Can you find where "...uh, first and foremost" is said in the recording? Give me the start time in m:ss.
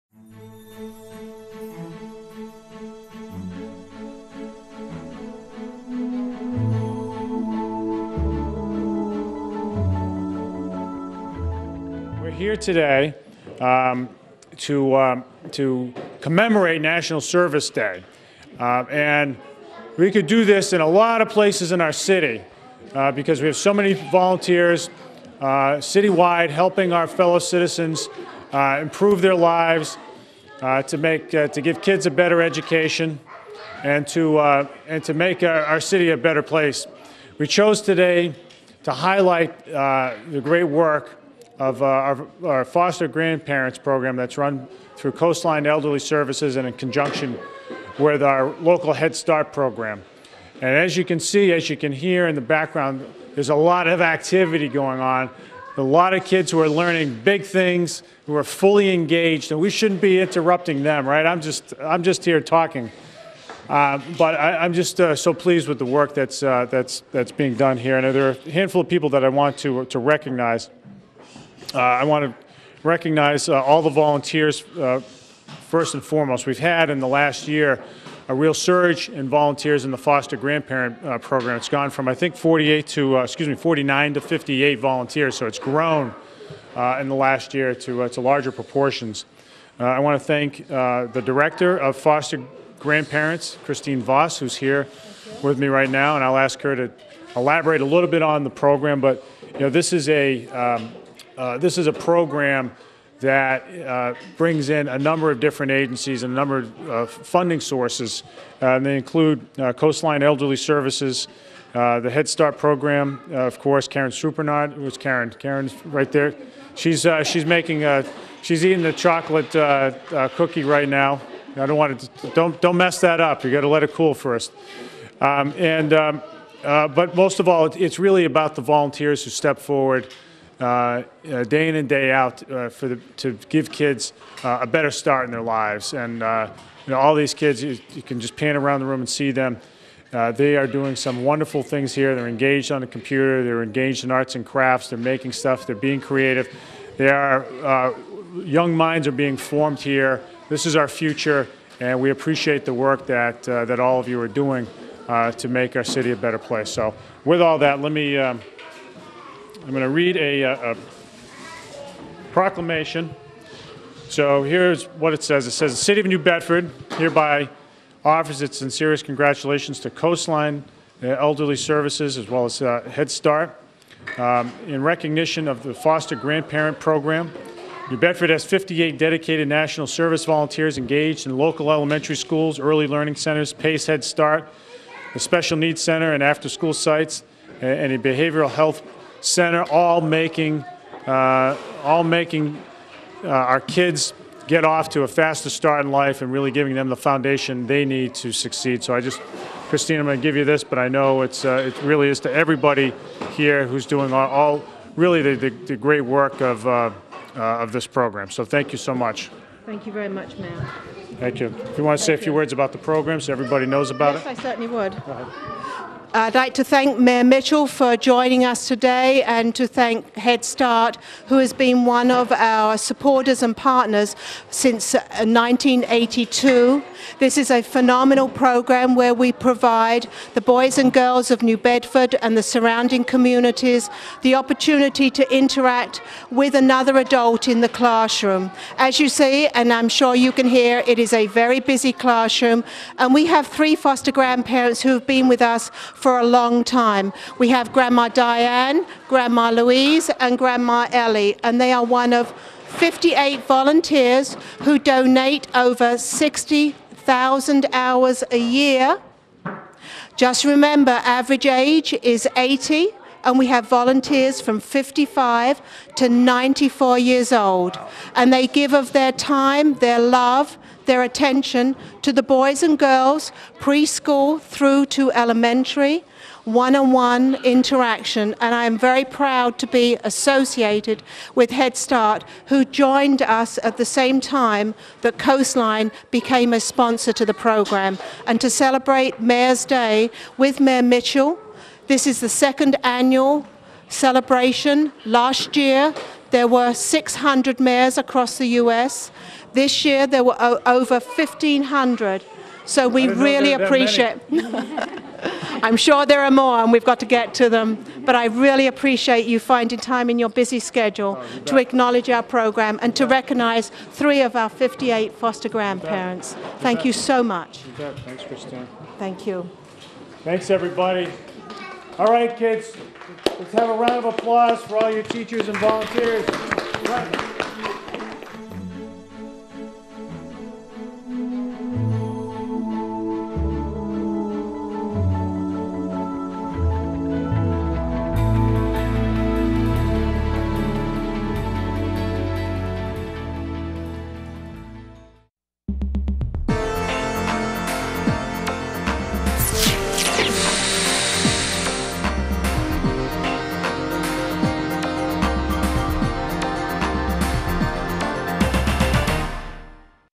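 1:14.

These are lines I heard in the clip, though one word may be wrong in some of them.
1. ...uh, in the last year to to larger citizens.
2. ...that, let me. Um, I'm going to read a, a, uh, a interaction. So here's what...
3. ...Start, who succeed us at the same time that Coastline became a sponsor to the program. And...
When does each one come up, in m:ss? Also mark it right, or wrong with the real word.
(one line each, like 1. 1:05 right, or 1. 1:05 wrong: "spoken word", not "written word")
1. 1:26 wrong: "proportions", not "citizens"
2. 2:37 wrong: "proclamation", not "interaction"
3. 4:41 wrong: "joined", not "succeed".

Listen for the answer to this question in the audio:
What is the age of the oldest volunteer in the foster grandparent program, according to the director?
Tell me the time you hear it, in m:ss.
4:26.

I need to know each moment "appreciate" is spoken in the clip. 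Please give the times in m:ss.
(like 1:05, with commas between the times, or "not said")
2:32, 5:03, 5:08.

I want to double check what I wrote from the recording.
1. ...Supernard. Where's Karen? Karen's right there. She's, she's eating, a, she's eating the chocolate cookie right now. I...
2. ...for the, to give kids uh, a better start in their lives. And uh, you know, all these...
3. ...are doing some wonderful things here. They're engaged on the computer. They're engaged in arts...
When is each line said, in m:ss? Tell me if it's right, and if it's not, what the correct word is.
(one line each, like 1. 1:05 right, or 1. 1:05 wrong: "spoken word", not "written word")
1. 1:54 wrong: "making", not "eating"
2. 2:12 right
3. 2:20 right.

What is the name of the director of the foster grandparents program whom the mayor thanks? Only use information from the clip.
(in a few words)
Christine Voss.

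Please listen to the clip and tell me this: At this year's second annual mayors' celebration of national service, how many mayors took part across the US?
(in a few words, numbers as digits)
over 1,500.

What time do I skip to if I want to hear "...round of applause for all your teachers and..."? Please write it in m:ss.
5:23.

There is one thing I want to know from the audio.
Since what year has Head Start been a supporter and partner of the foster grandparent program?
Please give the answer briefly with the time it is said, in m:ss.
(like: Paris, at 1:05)
1982, at 3:44.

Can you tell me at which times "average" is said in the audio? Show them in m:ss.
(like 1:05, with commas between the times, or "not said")
4:21.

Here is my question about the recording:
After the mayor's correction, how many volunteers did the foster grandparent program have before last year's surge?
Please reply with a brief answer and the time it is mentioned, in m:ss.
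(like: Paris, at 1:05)
49, at 1:23.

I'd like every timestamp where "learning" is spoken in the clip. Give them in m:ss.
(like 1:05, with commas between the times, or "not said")
0:56, 3:02.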